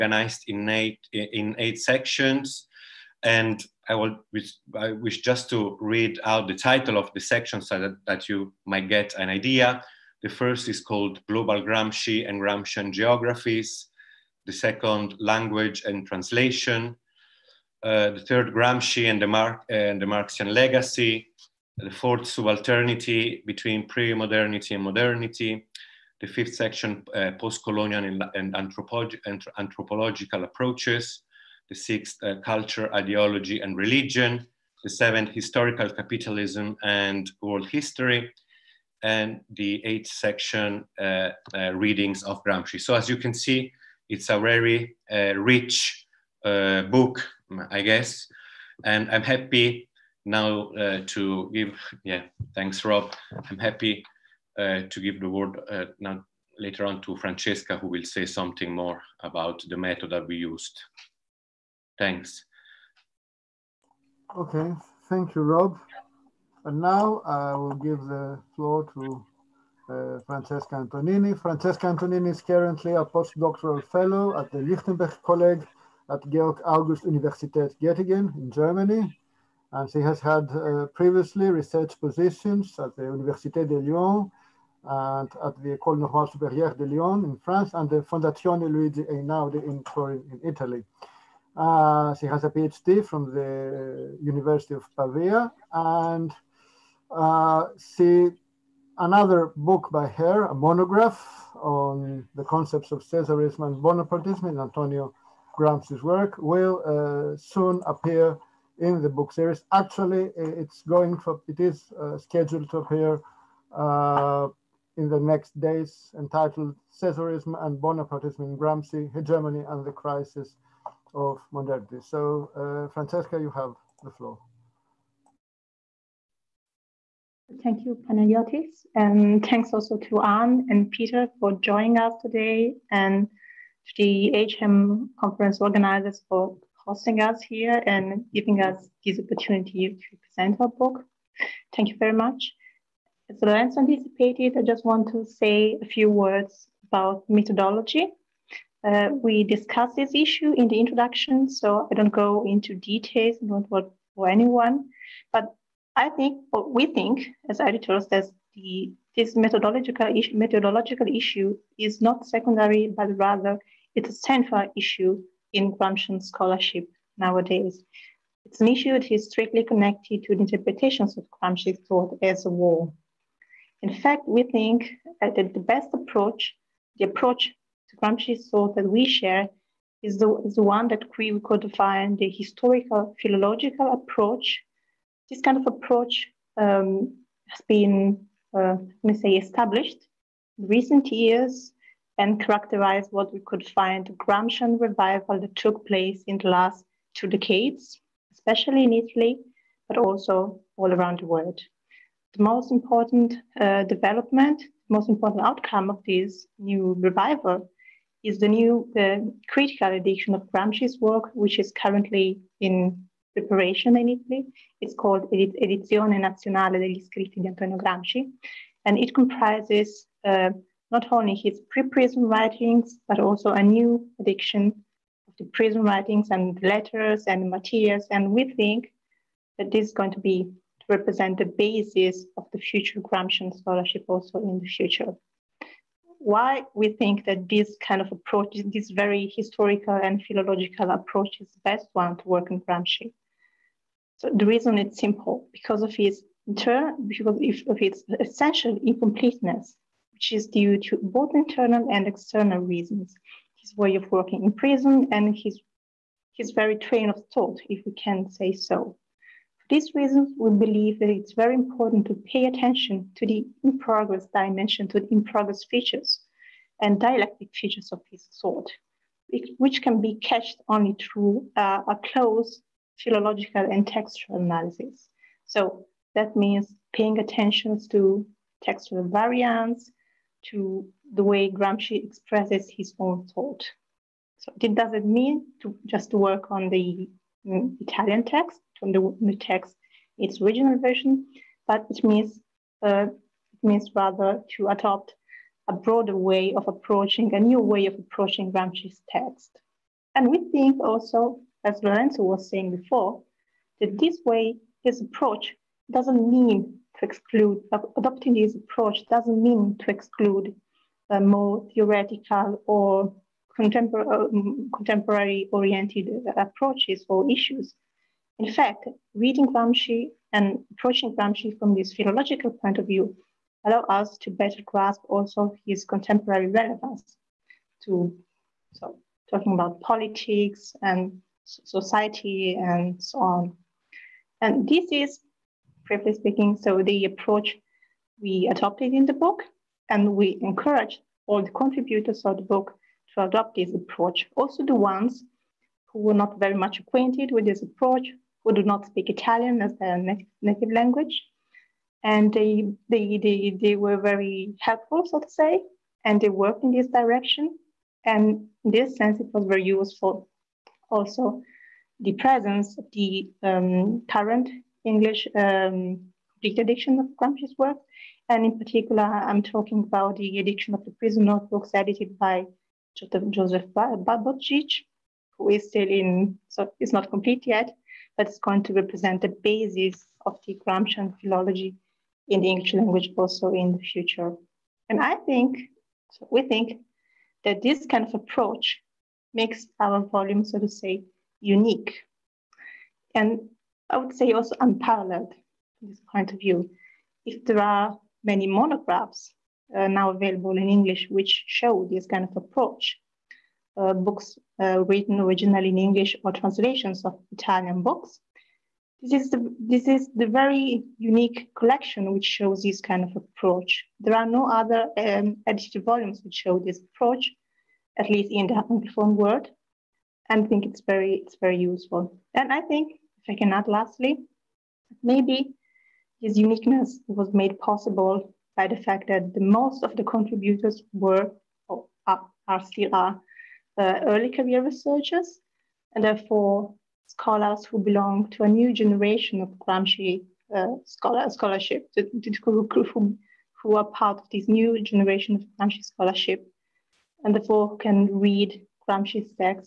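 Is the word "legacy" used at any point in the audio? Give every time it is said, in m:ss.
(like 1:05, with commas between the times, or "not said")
0:20.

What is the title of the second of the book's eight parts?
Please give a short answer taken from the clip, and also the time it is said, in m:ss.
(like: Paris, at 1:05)
Language and translation, at 0:15.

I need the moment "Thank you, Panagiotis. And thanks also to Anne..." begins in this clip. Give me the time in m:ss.
2:07.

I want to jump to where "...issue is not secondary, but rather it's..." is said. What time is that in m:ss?
2:41.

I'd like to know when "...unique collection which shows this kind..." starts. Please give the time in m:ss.
6:50.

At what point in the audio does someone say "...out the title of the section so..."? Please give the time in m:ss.
0:06.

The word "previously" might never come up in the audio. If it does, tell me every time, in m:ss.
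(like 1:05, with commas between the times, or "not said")
1:20.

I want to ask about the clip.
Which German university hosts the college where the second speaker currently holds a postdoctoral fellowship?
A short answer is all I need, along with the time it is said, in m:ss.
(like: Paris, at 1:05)
Georg August Universität Göttingen, at 1:16.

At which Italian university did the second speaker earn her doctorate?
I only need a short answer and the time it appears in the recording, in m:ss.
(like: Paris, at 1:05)
University of Pavia, at 1:34.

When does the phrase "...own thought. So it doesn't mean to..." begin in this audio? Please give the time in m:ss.
4:42.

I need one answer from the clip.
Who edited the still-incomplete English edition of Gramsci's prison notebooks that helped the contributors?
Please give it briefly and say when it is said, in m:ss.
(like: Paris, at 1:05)
Joseph Buttigieg, at 6:12.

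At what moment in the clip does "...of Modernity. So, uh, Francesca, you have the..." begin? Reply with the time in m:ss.
2:01.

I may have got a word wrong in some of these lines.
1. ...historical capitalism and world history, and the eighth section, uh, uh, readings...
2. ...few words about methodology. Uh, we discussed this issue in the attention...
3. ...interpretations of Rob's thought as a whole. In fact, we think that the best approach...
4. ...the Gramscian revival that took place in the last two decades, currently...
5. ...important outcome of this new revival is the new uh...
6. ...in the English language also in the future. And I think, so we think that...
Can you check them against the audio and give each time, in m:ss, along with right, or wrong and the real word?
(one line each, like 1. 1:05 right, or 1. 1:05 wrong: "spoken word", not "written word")
1. 0:35 right
2. 2:25 wrong: "introduction", not "attention"
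3. 2:50 wrong: "Gramsci", not "Rob"
4. 3:14 wrong: "especially", not "currently"
5. 3:25 right
6. 6:22 right.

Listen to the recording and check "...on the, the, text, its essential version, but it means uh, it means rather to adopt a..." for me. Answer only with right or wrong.
wrong.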